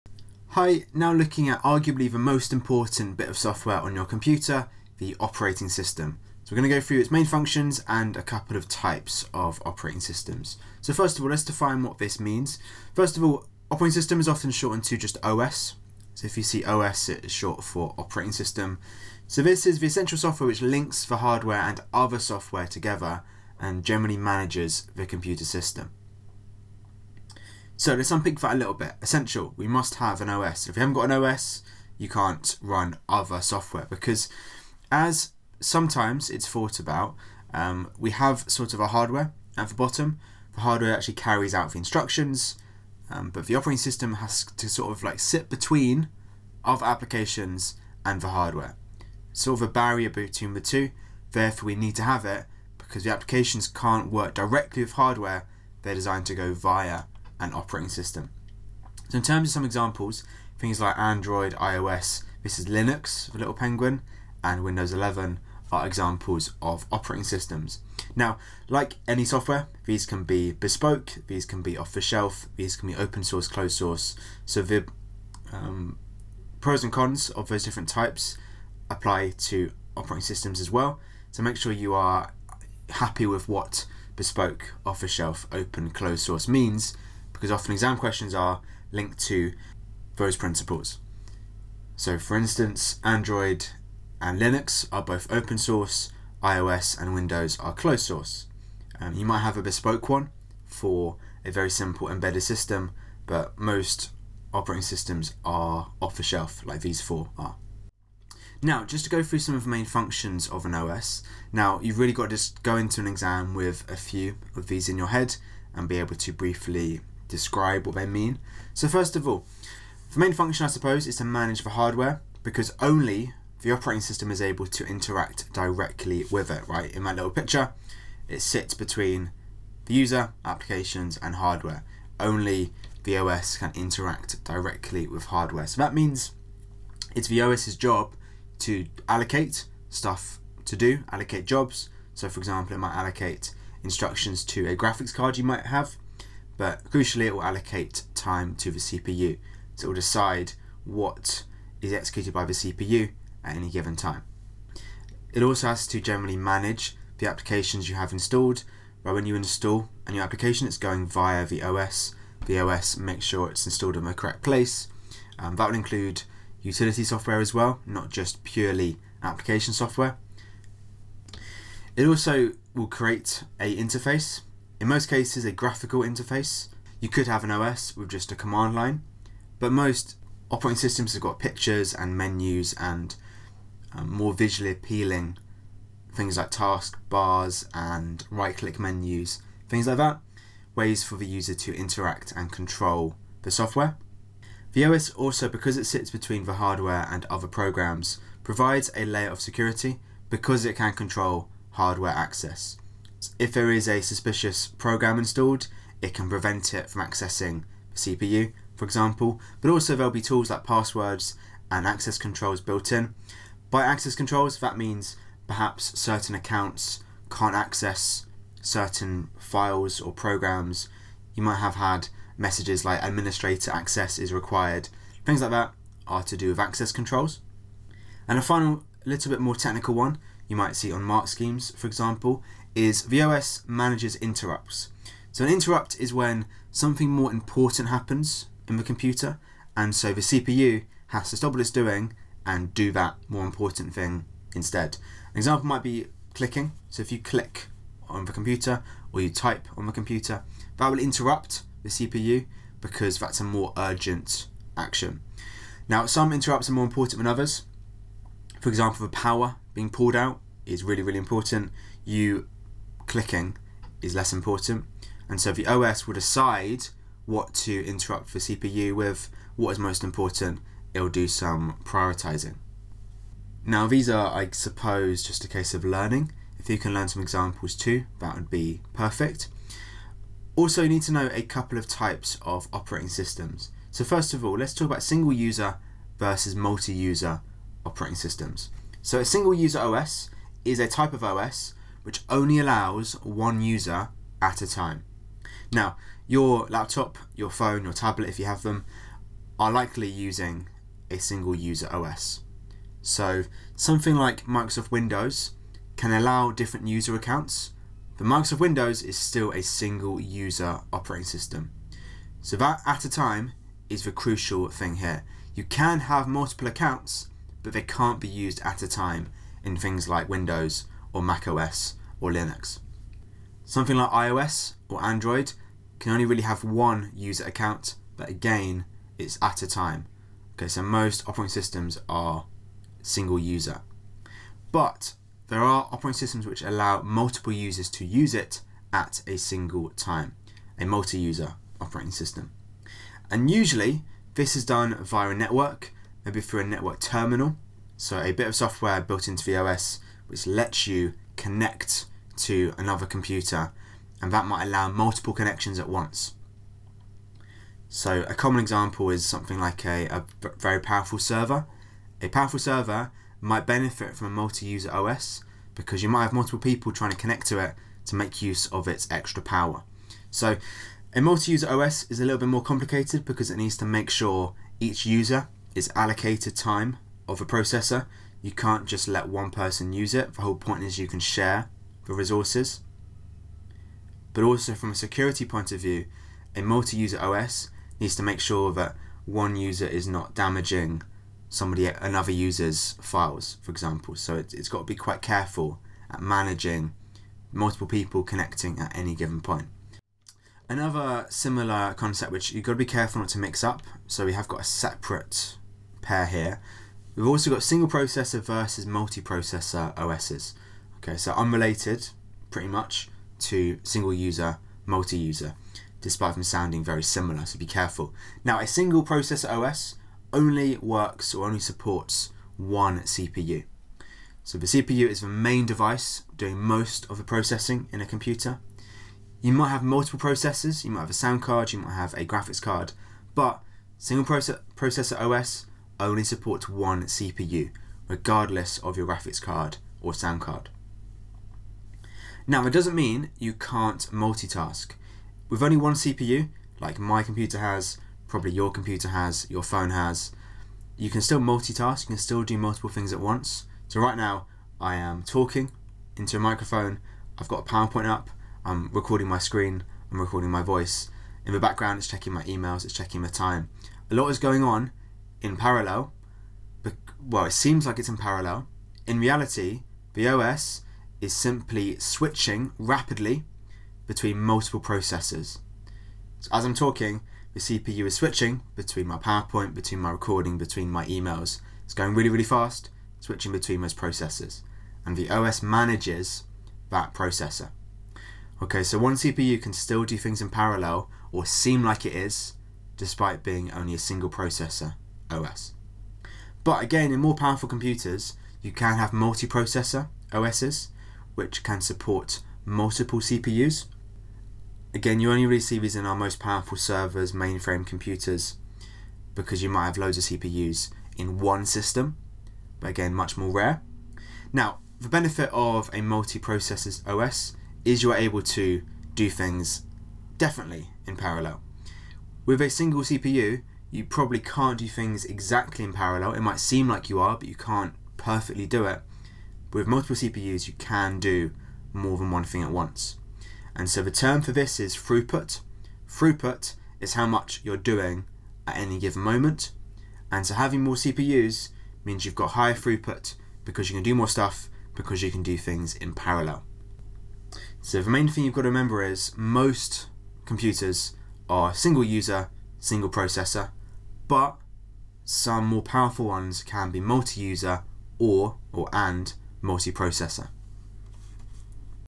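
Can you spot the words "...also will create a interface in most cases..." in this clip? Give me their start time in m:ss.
2:52.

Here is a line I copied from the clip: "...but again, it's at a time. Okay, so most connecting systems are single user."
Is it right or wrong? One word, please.
wrong.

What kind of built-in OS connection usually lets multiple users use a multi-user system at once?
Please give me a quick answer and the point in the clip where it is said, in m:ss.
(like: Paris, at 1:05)
network terminal, at 5:46.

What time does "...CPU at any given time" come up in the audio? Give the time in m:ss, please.
2:32.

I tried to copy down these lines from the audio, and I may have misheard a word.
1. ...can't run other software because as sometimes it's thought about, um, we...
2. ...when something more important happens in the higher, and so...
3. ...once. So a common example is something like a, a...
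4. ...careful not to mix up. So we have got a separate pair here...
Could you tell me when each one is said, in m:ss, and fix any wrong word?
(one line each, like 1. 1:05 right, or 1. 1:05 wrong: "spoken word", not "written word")
1. 0:32 right
2. 3:56 wrong: "computer", not "higher"
3. 5:55 right
4. 6:42 right.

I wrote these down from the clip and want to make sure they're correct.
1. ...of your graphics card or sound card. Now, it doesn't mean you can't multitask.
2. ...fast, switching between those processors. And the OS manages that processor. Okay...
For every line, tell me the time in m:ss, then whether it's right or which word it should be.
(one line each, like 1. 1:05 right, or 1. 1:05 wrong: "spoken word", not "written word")
1. 7:18 right
2. 8:02 right.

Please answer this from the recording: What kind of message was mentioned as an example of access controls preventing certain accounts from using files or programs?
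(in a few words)
administrator access is required.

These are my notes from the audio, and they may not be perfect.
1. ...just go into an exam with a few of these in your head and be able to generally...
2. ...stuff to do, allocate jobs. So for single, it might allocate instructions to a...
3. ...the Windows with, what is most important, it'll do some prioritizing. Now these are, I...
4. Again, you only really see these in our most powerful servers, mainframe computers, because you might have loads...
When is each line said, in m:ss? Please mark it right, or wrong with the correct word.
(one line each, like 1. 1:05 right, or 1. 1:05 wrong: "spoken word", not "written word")
1. 1:52 wrong: "briefly", not "generally"
2. 2:19 wrong: "example", not "single"
3. 4:28 wrong: "CPU", not "Windows"
4. 8:24 right.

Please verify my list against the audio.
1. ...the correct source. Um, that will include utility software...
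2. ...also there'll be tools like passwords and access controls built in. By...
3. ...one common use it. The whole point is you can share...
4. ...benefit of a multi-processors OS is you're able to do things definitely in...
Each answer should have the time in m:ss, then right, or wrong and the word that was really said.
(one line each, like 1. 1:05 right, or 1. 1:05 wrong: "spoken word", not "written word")
1. 2:44 wrong: "place", not "source"
2. 3:29 right
3. 6:19 wrong: "person", not "common"
4. 8:35 right.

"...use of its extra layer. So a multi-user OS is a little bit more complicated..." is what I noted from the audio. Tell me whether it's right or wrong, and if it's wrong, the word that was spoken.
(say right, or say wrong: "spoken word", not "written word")
wrong: "power", not "layer".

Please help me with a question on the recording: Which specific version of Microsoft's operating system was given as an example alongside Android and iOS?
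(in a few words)
Windows 11.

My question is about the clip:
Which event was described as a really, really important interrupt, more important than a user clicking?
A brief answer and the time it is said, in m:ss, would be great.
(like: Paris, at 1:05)
the power being pulled out, at 4:19.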